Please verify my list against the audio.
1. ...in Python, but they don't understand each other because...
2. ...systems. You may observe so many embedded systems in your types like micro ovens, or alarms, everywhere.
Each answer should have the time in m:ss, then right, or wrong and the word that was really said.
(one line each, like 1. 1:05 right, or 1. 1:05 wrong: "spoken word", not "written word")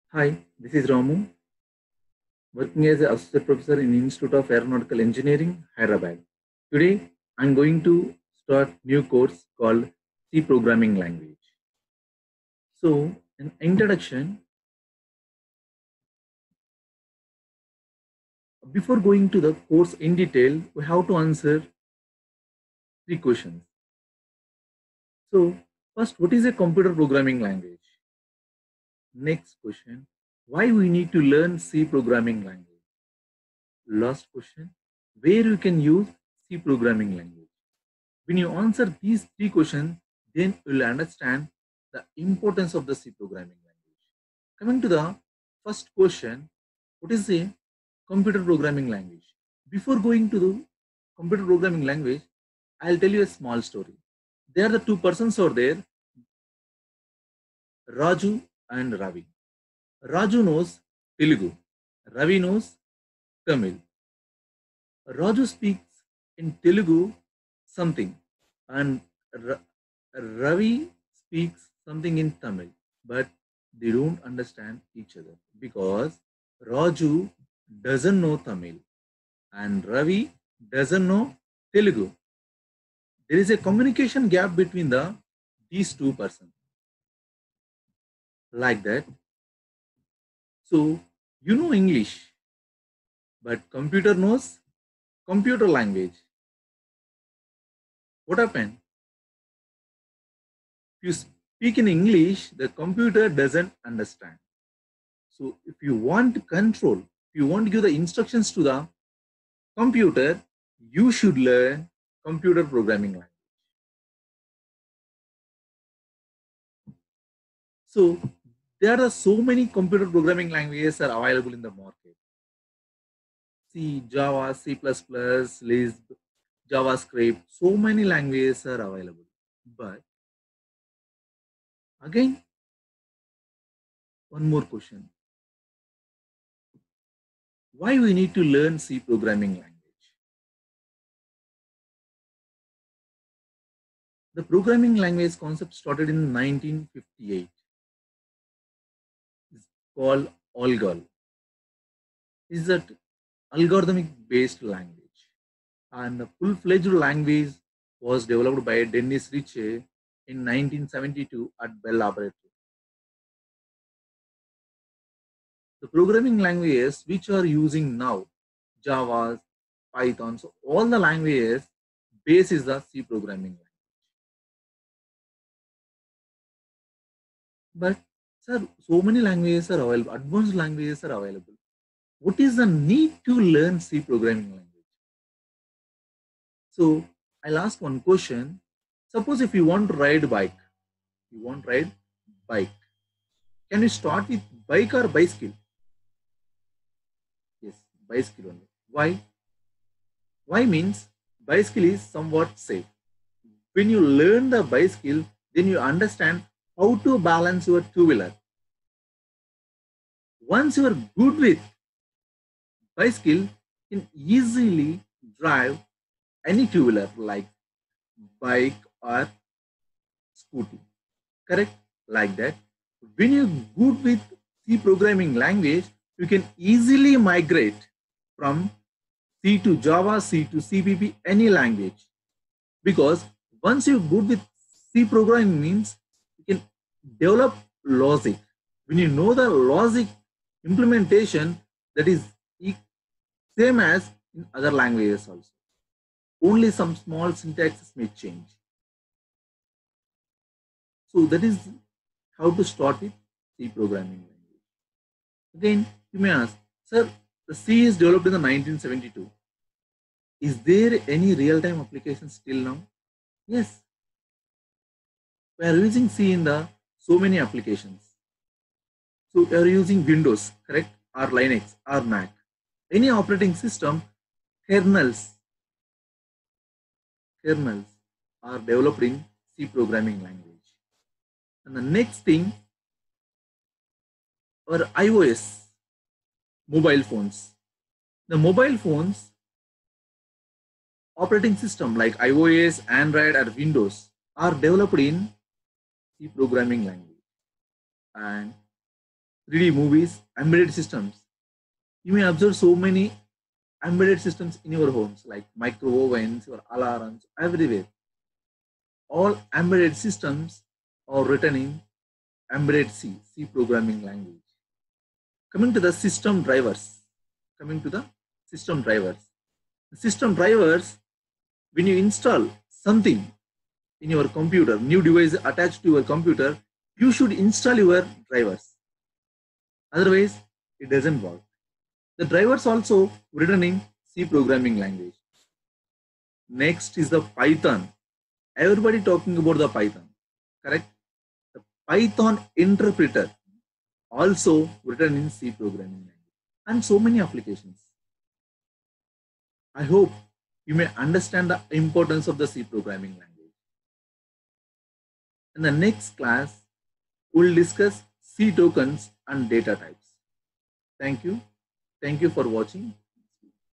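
1. 1:12 wrong: "Tamil", not "Python"
2. 5:00 wrong: "homes", not "types".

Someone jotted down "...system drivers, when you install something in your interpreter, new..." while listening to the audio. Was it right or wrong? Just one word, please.
wrong.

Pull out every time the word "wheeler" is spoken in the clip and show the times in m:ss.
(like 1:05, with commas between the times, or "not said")
3:27, 3:36.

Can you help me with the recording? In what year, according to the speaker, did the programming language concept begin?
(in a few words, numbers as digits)
1958.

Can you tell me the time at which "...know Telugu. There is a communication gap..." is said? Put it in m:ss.
1:21.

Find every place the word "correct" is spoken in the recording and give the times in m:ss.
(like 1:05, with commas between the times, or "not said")
3:41, 4:30, 5:40.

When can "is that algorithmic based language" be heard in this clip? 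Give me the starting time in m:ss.
2:32.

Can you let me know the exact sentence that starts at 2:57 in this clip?
But Sir, so many languages are available, advanced languages are available.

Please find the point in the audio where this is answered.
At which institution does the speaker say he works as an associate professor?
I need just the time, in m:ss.
0:03.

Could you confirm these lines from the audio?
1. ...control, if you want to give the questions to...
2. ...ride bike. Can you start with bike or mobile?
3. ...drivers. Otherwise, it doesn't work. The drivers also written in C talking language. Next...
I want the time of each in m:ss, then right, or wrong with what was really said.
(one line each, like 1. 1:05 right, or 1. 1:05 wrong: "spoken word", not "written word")
1. 1:46 wrong: "instructions", not "questions"
2. 3:11 wrong: "bicycle", not "mobile"
3. 5:28 wrong: "programming", not "talking".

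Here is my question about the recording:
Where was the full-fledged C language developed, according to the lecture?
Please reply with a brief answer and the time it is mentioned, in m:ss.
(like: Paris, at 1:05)
Bell Laboratory, at 2:41.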